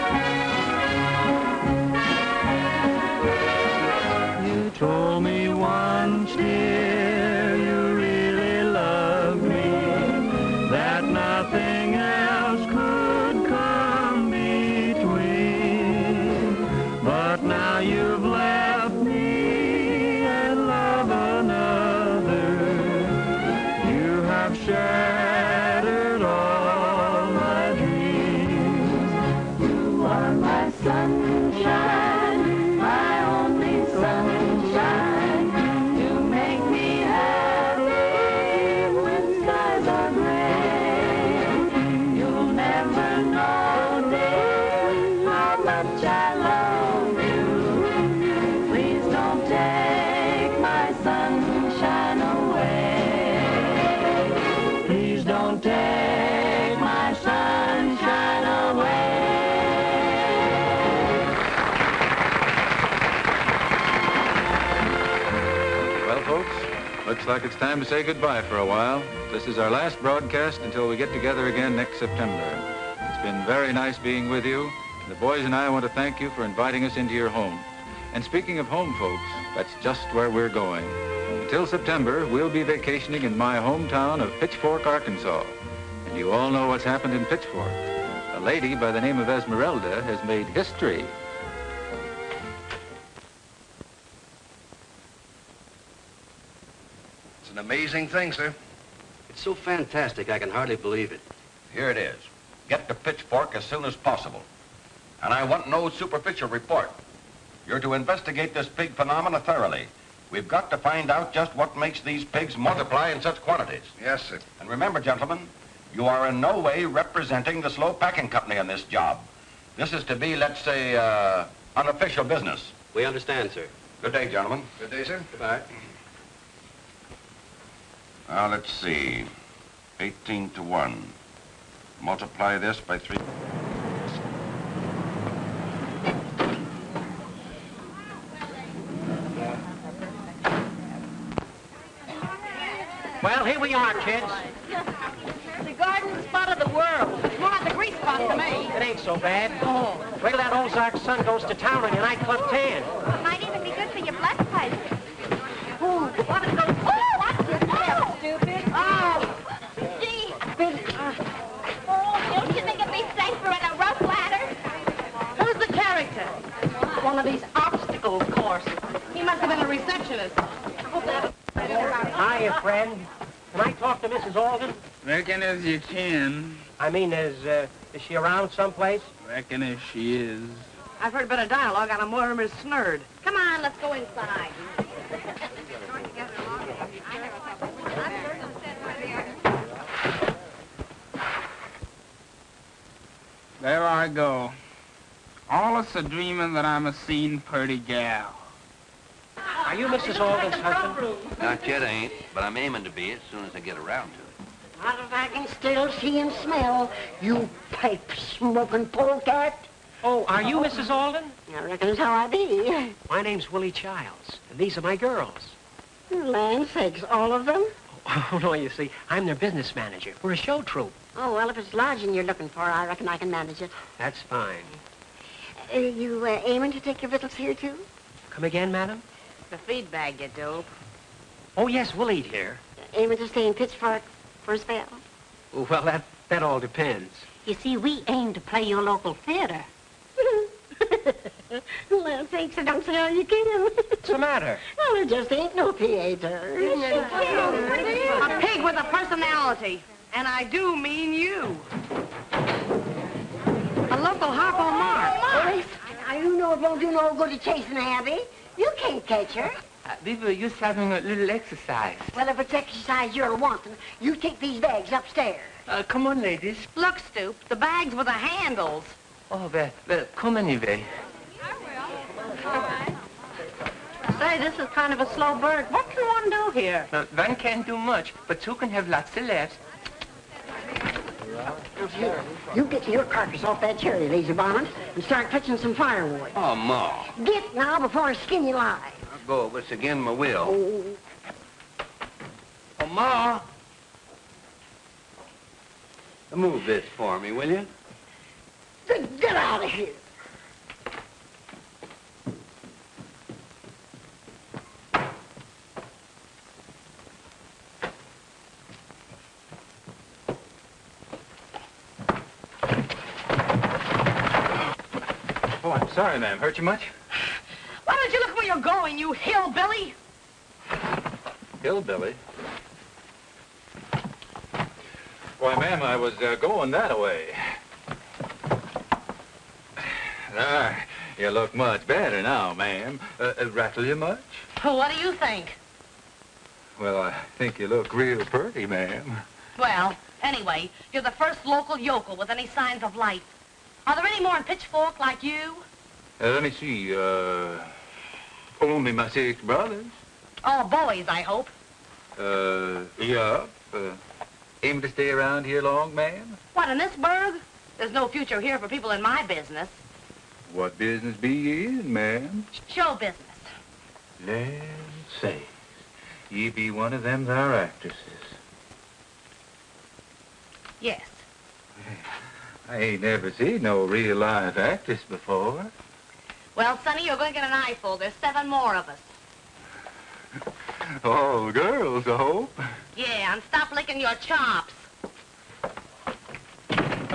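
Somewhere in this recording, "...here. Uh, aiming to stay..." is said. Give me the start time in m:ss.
3:52.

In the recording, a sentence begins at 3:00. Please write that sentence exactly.
I've heard a bit of dialogue on of Mortimer Snerd.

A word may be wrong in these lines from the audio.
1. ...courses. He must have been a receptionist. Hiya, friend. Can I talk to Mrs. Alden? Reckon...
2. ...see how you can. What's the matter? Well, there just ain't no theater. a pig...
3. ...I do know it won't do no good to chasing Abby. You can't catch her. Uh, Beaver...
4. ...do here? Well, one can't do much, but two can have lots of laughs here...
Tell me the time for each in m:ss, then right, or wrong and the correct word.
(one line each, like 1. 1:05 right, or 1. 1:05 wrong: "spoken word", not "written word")
1. 2:48 right
2. 4:02 right
3. 4:16 right
4. 4:36 right.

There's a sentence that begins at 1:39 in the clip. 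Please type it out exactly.
It's so fantastic, I can hardly believe it.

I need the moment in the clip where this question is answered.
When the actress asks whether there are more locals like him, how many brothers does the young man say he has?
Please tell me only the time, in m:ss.
5:49.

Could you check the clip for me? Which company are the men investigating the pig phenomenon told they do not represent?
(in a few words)
Slowe Packing Company.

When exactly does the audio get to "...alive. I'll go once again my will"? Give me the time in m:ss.
4:48.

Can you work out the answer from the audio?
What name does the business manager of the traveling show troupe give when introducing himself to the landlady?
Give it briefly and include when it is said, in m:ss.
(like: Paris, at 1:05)
Willie Childs, at 3:33.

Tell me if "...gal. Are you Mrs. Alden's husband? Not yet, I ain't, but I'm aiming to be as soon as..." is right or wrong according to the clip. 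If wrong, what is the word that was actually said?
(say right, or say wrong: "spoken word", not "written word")
right.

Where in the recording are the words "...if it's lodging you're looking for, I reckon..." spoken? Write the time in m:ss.
3:41.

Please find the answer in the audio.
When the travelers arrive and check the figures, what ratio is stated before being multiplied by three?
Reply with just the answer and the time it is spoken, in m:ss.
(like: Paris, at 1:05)
18 to 1, at 2:09.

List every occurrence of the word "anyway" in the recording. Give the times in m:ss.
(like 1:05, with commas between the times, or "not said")
4:30, 5:40.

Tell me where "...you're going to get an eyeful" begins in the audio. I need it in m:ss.
6:17.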